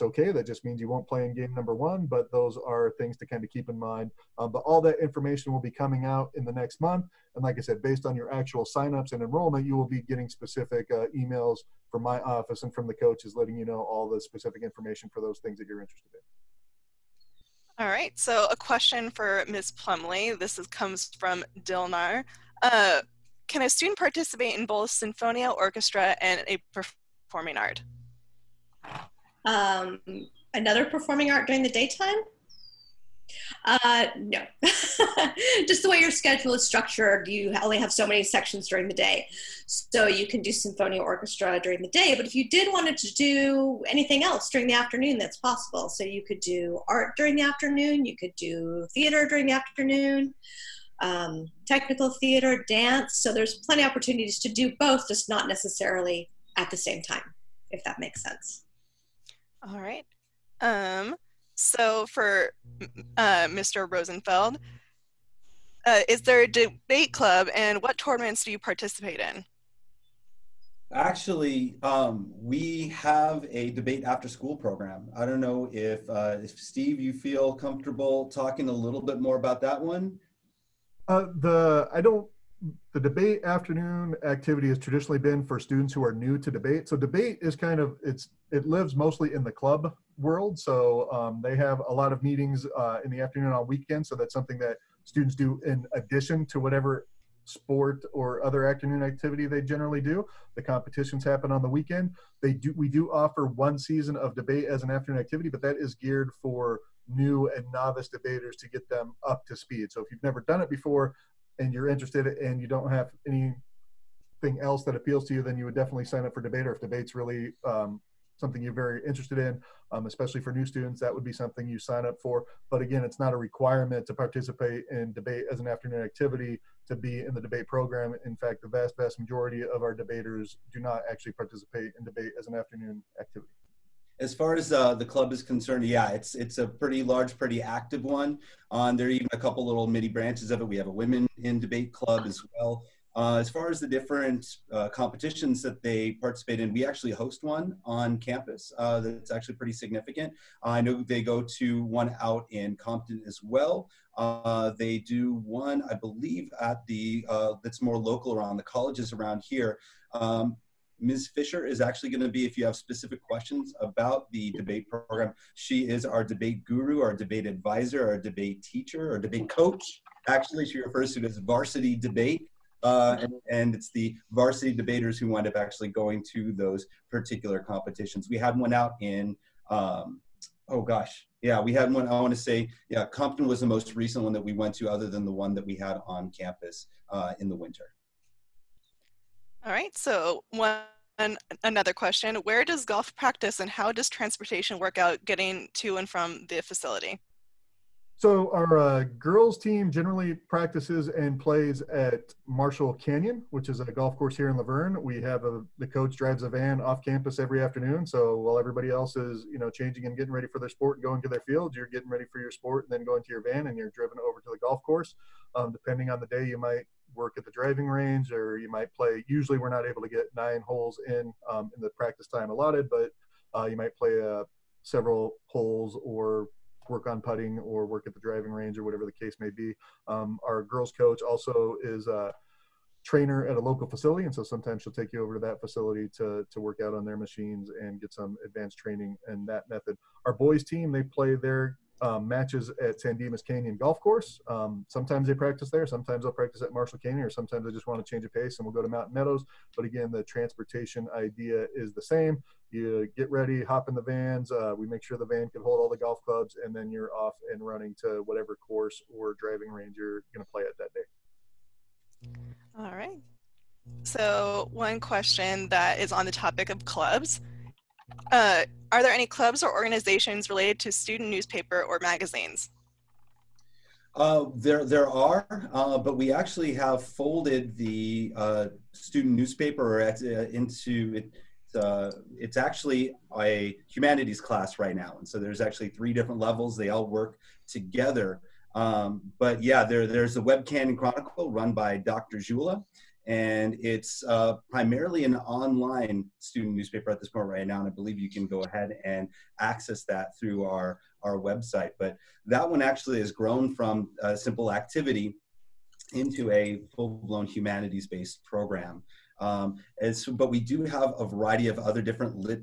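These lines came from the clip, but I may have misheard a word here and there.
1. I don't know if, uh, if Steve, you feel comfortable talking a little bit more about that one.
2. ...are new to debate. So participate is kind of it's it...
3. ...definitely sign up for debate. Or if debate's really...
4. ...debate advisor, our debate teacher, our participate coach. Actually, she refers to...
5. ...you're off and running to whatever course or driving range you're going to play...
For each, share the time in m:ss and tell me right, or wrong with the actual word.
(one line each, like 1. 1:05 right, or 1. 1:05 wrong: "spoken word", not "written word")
1. 1:15 right
2. 1:26 wrong: "debate", not "participate"
3. 1:55 right
4. 2:47 wrong: "debate", not "participate"
5. 4:16 right.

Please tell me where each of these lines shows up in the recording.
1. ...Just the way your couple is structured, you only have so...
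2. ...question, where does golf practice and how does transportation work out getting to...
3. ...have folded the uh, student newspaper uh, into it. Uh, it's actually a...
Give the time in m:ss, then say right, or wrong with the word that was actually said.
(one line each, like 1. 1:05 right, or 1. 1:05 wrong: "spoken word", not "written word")
1. 0:35 wrong: "schedule", not "couple"
2. 3:11 right
3. 4:36 right.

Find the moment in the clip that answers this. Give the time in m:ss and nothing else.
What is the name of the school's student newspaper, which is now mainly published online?
4:50.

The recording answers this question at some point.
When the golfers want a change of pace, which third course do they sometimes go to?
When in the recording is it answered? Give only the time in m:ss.
4:08.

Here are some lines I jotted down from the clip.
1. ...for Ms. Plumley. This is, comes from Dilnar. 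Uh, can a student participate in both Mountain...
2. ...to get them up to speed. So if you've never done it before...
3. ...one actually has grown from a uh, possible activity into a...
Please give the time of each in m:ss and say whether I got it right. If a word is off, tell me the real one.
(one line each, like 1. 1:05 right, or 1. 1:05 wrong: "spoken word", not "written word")
1. 0:19 wrong: "Sinfonia", not "Mountain"
2. 1:48 right
3. 5:02 wrong: "simple", not "possible".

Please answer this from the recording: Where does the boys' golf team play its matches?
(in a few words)
San Dimas Canyon Golf Course.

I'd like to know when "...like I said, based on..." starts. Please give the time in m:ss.
0:07.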